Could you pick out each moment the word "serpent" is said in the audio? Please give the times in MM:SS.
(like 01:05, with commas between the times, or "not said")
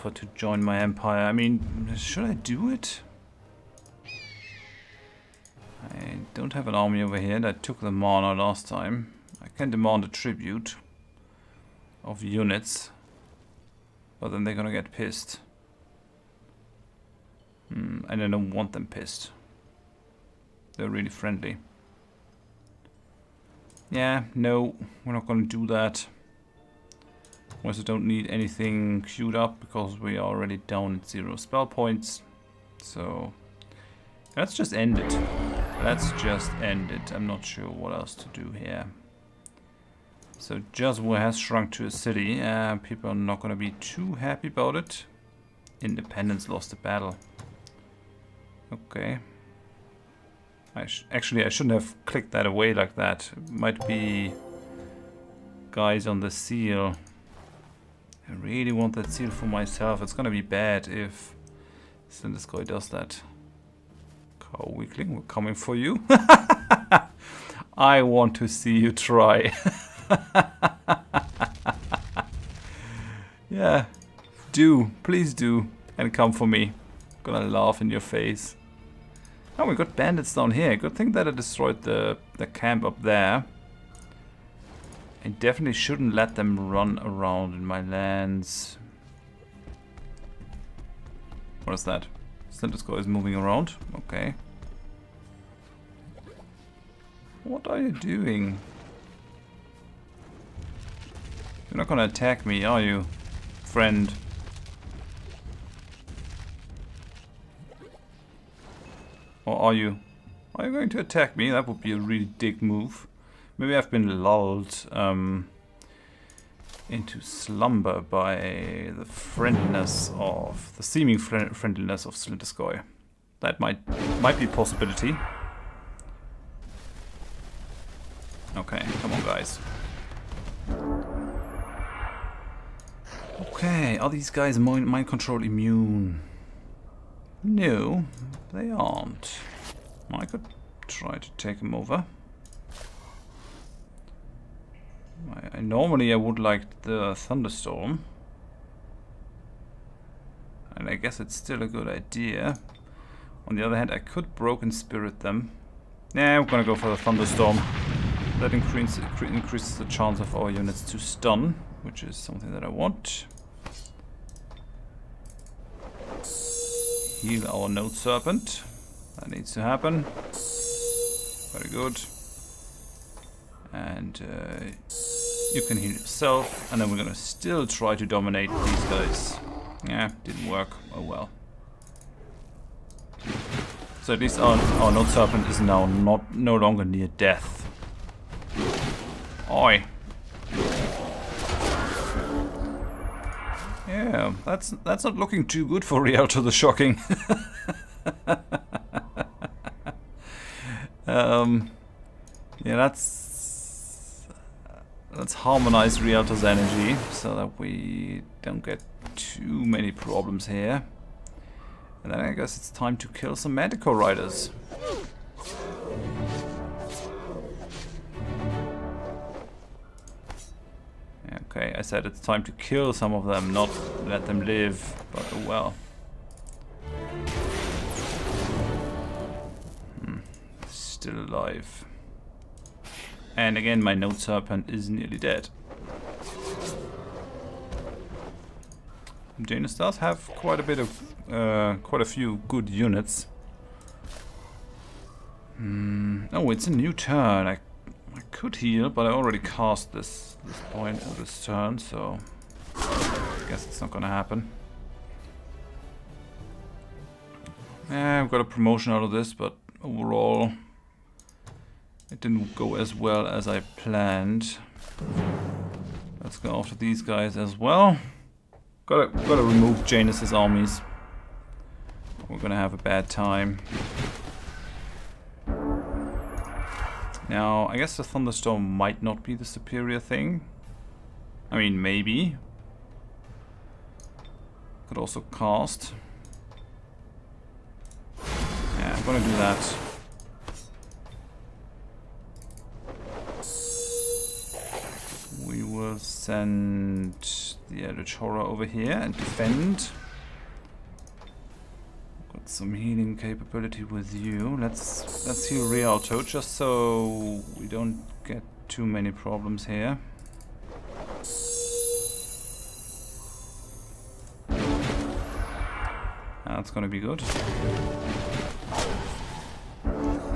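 02:47, 03:05, 03:54.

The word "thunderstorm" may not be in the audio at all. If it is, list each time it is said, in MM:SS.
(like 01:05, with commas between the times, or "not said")
02:27, 02:36, 04:38.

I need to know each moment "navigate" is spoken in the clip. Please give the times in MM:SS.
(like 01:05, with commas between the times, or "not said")
not said.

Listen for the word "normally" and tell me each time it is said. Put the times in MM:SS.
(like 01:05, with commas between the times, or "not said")
02:25.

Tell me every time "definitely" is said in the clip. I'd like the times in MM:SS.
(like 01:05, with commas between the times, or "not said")
01:25.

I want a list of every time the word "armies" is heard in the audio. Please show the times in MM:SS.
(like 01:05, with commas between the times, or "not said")
04:30.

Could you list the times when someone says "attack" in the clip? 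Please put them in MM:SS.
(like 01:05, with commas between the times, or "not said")
01:42, 01:50.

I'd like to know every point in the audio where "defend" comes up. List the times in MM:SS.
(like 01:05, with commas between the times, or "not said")
04:59.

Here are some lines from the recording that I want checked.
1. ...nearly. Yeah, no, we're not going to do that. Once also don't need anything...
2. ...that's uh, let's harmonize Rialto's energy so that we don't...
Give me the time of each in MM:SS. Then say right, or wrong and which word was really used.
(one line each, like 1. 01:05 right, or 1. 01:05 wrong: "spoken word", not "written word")
1. 00:21 wrong: "friendly", not "nearly"
2. 03:22 right.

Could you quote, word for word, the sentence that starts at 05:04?
Let's let's heal Rialto just so we don't get too many problems here.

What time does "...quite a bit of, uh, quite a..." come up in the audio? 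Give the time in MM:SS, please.
04:00.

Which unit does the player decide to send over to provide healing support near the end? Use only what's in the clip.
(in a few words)
Eldritch Horror.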